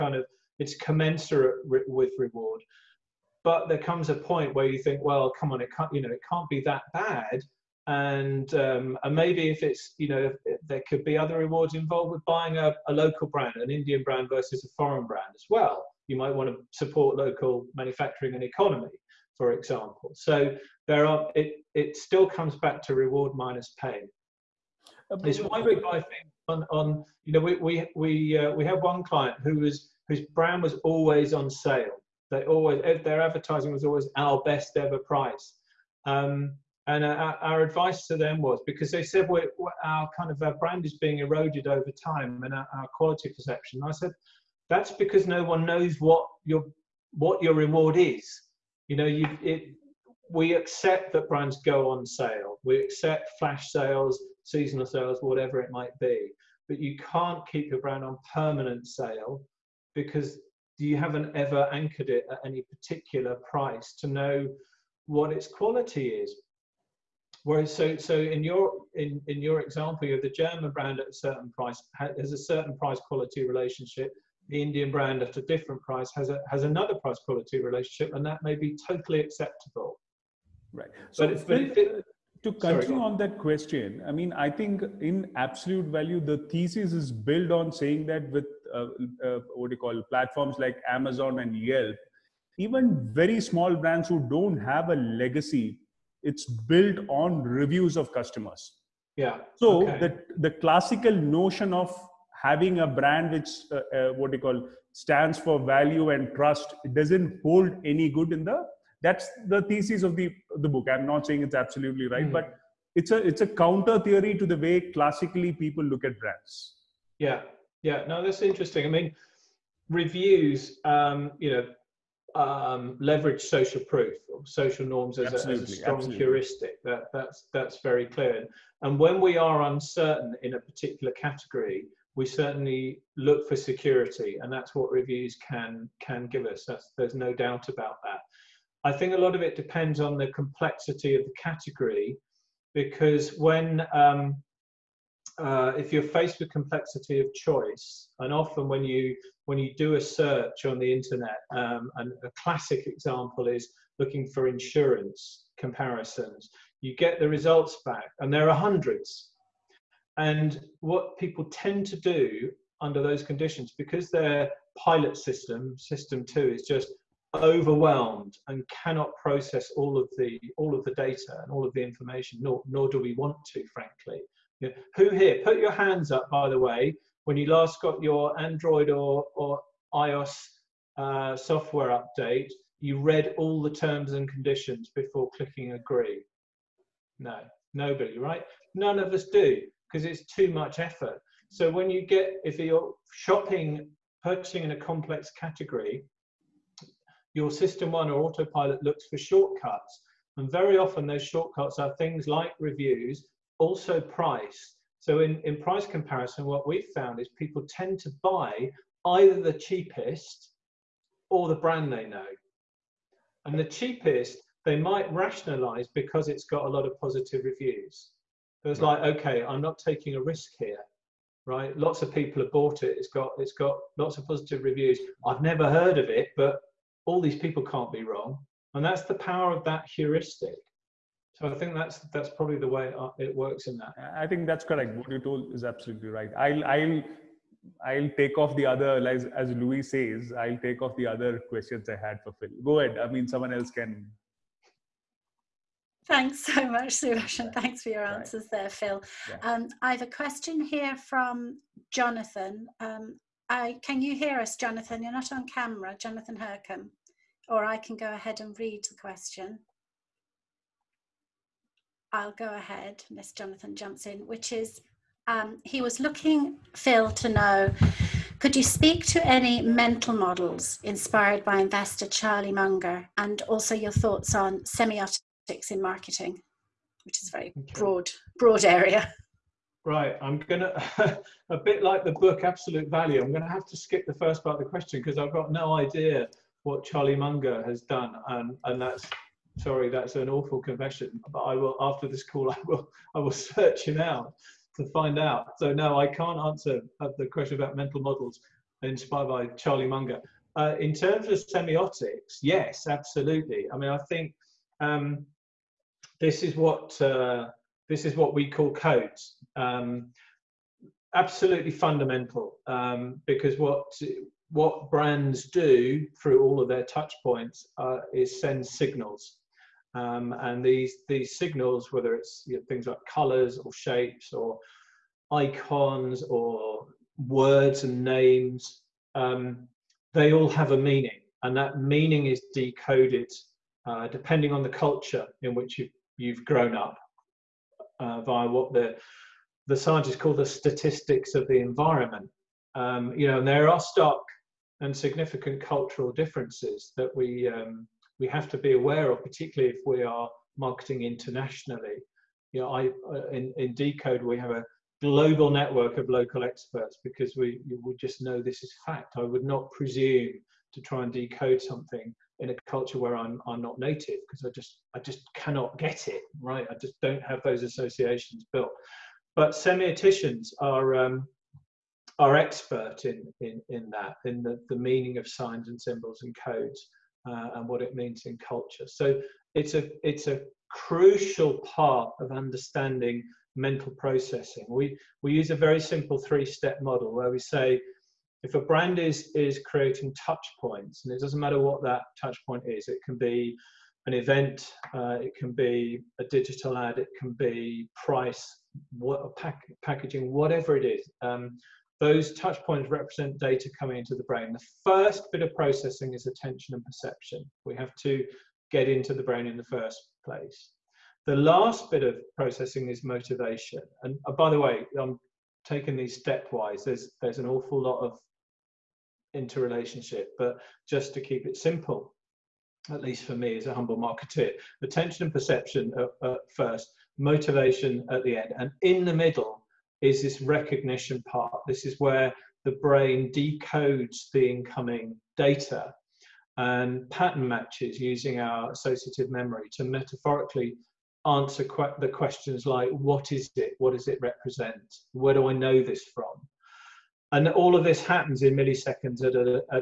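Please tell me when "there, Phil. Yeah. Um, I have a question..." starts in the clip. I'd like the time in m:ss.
4:08.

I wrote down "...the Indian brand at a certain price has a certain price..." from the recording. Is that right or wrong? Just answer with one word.
wrong.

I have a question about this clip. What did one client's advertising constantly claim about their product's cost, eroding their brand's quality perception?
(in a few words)
Our best ever price.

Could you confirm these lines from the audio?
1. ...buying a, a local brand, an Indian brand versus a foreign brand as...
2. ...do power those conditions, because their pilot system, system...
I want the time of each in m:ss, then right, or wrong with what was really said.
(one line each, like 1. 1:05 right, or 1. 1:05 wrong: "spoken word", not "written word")
1. 0:12 right
2. 2:42 wrong: "under", not "power".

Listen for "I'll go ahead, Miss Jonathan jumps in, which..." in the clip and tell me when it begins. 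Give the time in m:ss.
4:22.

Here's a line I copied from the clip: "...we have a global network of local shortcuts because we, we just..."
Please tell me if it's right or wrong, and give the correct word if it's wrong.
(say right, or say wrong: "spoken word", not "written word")
wrong: "experts", not "shortcuts".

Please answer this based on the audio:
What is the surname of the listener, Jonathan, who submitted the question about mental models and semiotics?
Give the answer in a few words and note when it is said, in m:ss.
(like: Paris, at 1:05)
Hercombe, at 4:16.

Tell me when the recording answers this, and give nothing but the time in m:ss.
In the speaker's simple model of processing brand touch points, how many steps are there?
6:26.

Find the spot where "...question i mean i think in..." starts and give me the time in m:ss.
1:23.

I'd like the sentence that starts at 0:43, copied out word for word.
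And I said that's because no one knows what your what your reward is.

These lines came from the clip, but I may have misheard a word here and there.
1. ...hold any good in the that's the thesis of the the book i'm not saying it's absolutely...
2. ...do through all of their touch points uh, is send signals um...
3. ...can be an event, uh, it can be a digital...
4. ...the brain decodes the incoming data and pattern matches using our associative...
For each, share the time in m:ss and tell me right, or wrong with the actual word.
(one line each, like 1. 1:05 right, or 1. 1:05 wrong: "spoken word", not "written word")
1. 1:47 right
2. 5:15 right
3. 6:33 right
4. 7:12 right.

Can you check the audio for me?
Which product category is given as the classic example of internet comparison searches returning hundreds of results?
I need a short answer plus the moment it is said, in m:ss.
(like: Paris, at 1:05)
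Insurance, at 2:34.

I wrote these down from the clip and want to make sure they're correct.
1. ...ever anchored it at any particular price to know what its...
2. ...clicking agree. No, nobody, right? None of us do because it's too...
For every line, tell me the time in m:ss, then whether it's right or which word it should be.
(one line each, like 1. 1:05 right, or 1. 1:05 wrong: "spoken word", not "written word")
1. 1:01 right
2. 3:05 right.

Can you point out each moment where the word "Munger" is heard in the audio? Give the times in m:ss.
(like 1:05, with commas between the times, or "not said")
4:32, 4:47, 4:59.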